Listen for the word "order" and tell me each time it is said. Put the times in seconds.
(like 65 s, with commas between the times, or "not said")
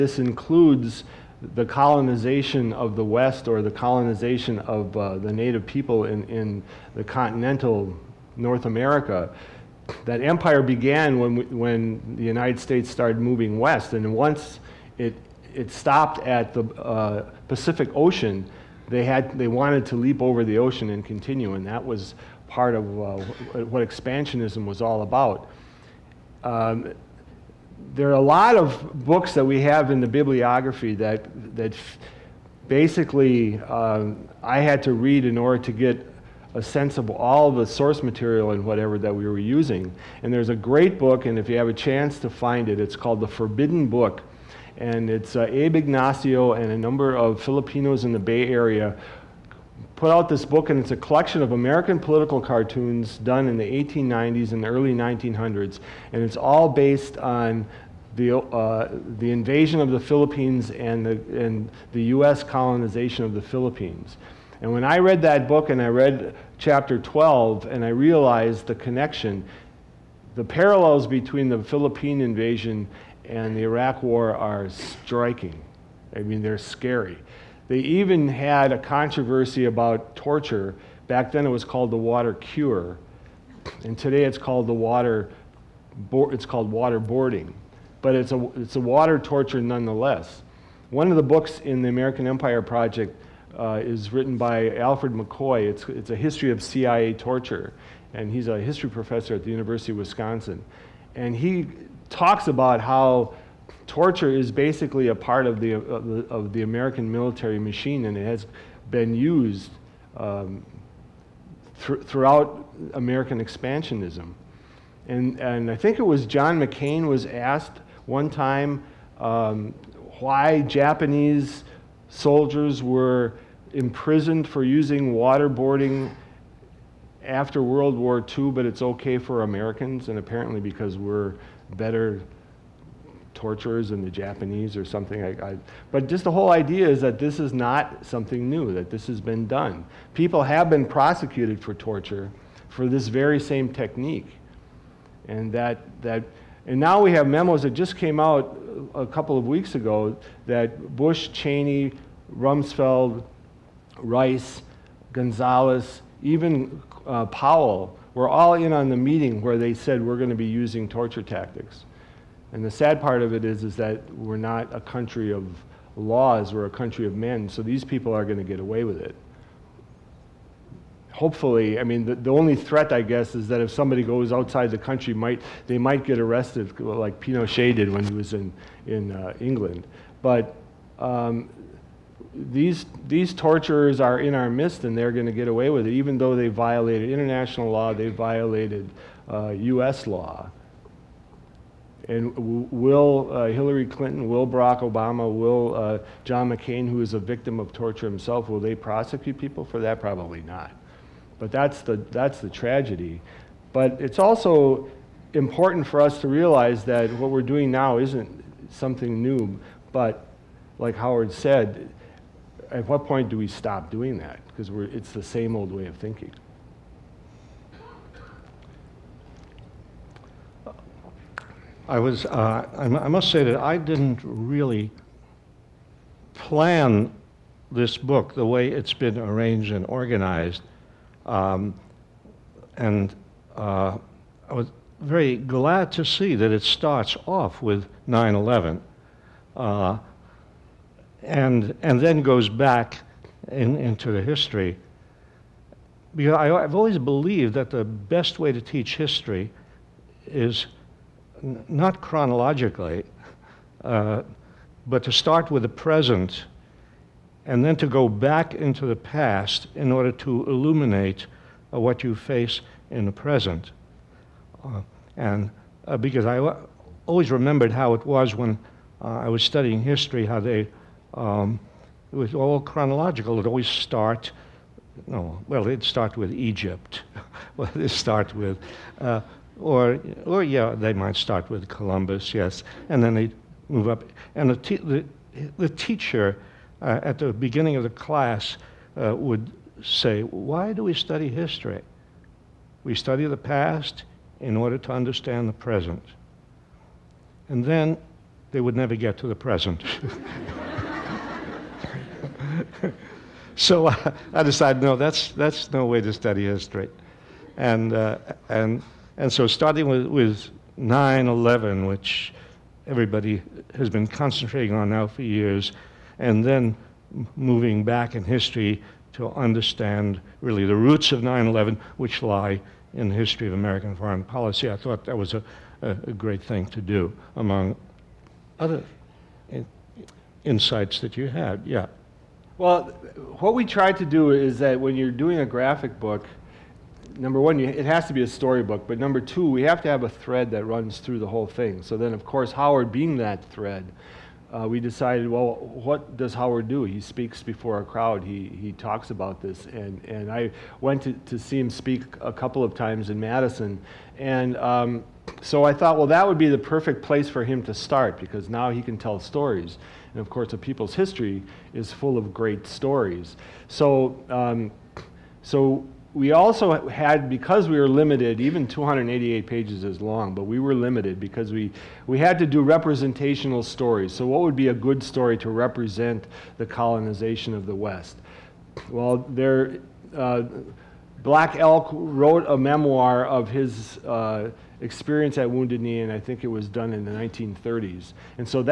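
35 s, 259 s, 294 s.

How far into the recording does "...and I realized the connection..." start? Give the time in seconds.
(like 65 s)
67 s.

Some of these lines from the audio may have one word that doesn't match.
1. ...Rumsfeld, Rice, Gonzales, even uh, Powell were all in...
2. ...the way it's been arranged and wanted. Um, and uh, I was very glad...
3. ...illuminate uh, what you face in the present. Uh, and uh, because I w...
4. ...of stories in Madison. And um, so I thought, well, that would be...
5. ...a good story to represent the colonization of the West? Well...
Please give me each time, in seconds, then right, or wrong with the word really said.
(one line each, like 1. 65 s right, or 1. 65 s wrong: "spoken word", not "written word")
1. 152 s right
2. 228 s wrong: "organized", not "wanted"
3. 260 s right
4. 352 s wrong: "times", not "stories"
5. 374 s right.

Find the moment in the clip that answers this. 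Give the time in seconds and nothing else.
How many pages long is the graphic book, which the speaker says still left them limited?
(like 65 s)
368 s.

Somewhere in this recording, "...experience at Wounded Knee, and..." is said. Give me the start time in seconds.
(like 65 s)
384 s.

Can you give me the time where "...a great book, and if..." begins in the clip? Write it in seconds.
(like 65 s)
40 s.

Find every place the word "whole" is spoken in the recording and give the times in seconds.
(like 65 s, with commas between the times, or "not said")
136 s, 341 s.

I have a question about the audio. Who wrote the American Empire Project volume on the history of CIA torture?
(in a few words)
Alfred McCoy.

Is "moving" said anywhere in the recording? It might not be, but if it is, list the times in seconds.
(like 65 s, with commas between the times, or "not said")
13 s, 317 s.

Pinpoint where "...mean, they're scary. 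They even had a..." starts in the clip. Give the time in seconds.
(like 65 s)
76 s.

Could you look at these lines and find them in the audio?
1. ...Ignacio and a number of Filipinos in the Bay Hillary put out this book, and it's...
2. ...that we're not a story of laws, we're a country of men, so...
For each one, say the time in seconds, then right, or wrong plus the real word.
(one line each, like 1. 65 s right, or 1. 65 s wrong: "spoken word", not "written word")
1. 45 s wrong: "Area", not "Hillary"
2. 163 s wrong: "country", not "story".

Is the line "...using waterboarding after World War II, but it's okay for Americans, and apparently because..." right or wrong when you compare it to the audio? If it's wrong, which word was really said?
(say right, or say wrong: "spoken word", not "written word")
right.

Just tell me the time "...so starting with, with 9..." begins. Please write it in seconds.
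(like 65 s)
309 s.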